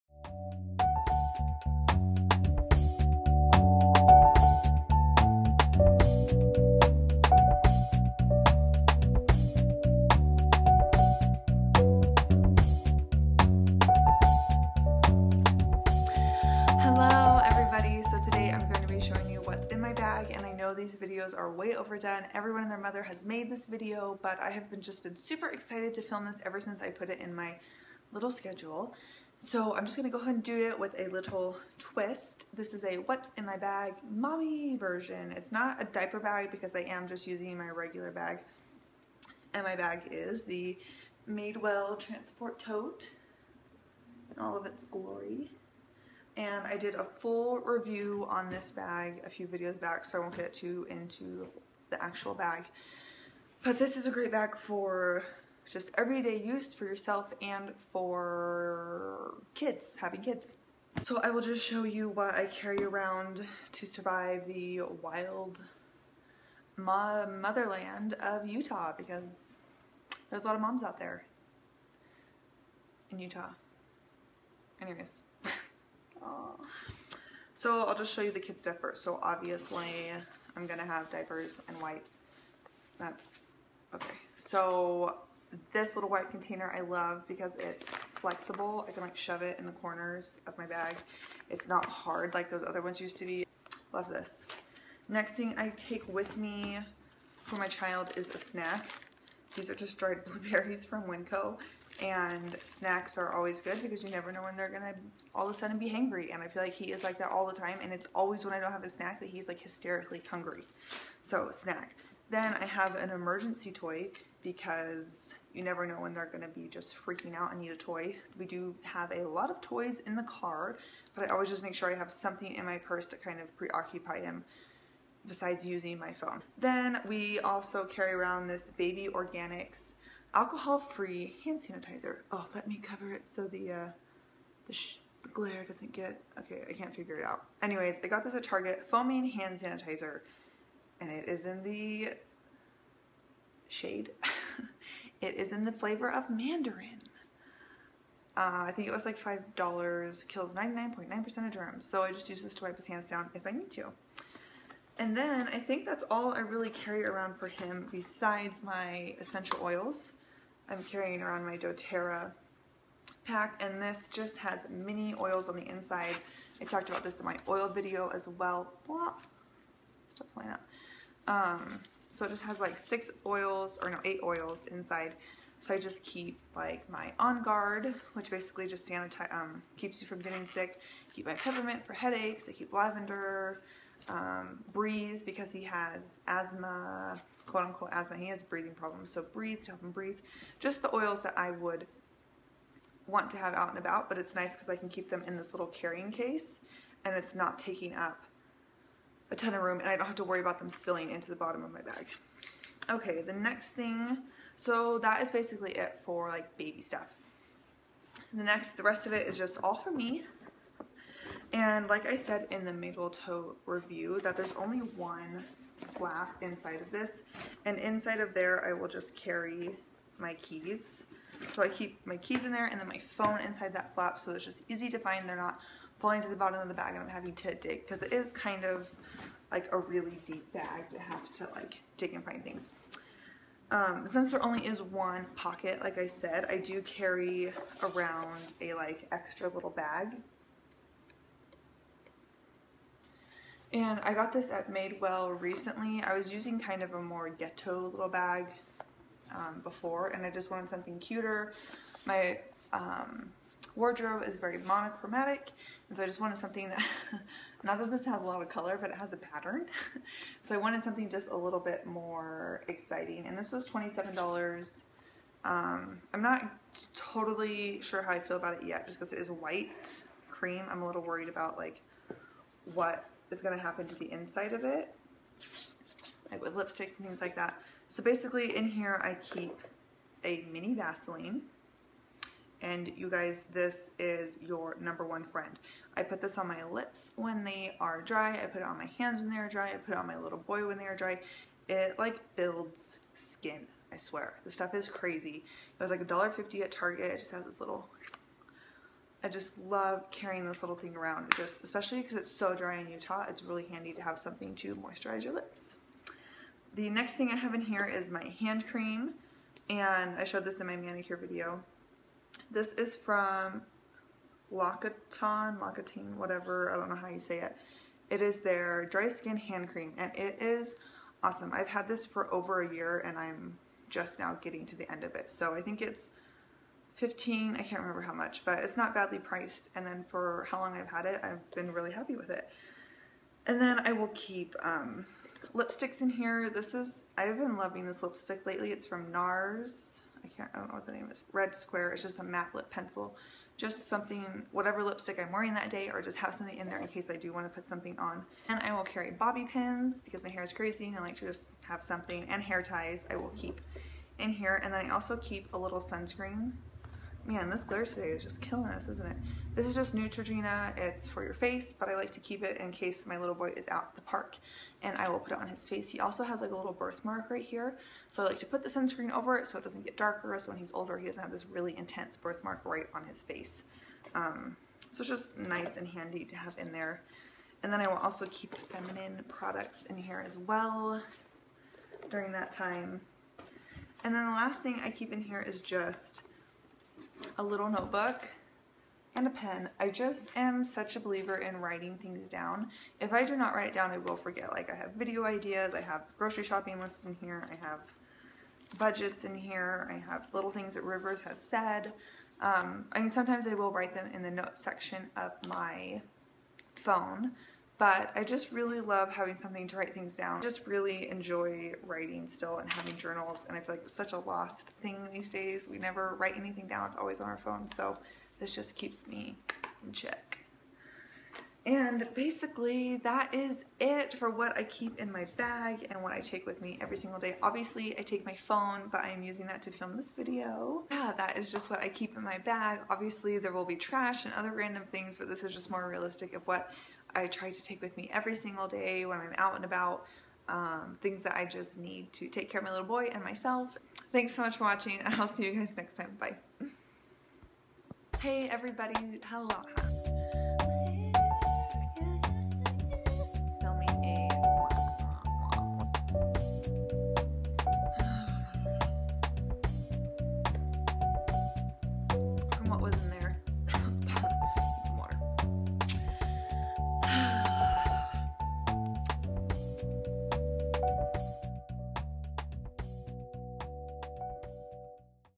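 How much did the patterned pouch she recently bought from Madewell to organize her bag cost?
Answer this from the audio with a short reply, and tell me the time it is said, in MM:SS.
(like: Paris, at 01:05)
$27, at 04:23.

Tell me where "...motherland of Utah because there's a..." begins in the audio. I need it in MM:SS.
01:06.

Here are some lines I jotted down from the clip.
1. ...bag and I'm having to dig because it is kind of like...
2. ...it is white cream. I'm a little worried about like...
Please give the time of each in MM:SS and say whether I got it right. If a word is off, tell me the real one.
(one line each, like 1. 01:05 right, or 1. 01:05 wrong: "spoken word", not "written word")
1. 03:46 right
2. 04:29 right.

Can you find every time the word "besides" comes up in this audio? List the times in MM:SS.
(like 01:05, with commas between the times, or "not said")
02:05, 02:37.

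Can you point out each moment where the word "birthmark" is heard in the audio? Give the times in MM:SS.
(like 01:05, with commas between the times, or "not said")
06:06, 06:12.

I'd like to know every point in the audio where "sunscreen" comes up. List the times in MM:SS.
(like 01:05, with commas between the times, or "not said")
05:55, 06:08.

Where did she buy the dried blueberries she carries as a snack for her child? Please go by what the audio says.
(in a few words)
Winco.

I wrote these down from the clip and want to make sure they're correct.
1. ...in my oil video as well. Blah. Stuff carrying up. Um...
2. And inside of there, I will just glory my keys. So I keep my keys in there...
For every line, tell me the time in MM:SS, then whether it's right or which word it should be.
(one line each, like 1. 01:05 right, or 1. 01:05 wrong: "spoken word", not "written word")
1. 02:47 wrong: "flying", not "carrying"
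2. 03:37 wrong: "carry", not "glory".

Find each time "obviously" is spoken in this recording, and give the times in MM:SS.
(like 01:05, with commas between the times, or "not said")
01:19, 07:07, 07:12.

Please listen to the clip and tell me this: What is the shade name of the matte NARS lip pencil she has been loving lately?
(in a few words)
Red Square.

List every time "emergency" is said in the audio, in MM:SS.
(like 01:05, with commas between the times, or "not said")
01:53.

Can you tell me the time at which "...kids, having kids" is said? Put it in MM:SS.
00:59.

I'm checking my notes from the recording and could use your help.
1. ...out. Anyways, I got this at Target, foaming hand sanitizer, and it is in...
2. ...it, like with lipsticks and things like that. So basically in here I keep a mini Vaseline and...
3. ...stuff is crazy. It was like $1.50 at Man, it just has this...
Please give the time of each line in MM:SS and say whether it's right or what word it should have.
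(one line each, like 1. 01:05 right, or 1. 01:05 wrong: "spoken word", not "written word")
1. 02:17 right
2. 04:34 right
3. 04:54 wrong: "Target", not "Man".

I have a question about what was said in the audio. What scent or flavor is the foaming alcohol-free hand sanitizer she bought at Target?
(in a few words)
Mandarin.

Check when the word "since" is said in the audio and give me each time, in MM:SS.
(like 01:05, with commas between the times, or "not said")
00:26, 03:54.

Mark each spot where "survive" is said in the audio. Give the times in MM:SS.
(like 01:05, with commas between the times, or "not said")
01:03.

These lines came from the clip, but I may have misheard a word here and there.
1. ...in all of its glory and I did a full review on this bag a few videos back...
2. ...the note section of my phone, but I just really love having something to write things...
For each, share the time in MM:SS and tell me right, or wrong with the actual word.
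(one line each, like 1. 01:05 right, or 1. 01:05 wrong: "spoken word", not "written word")
1. 00:44 right
2. 06:44 right.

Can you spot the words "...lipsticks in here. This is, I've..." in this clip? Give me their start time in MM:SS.
05:35.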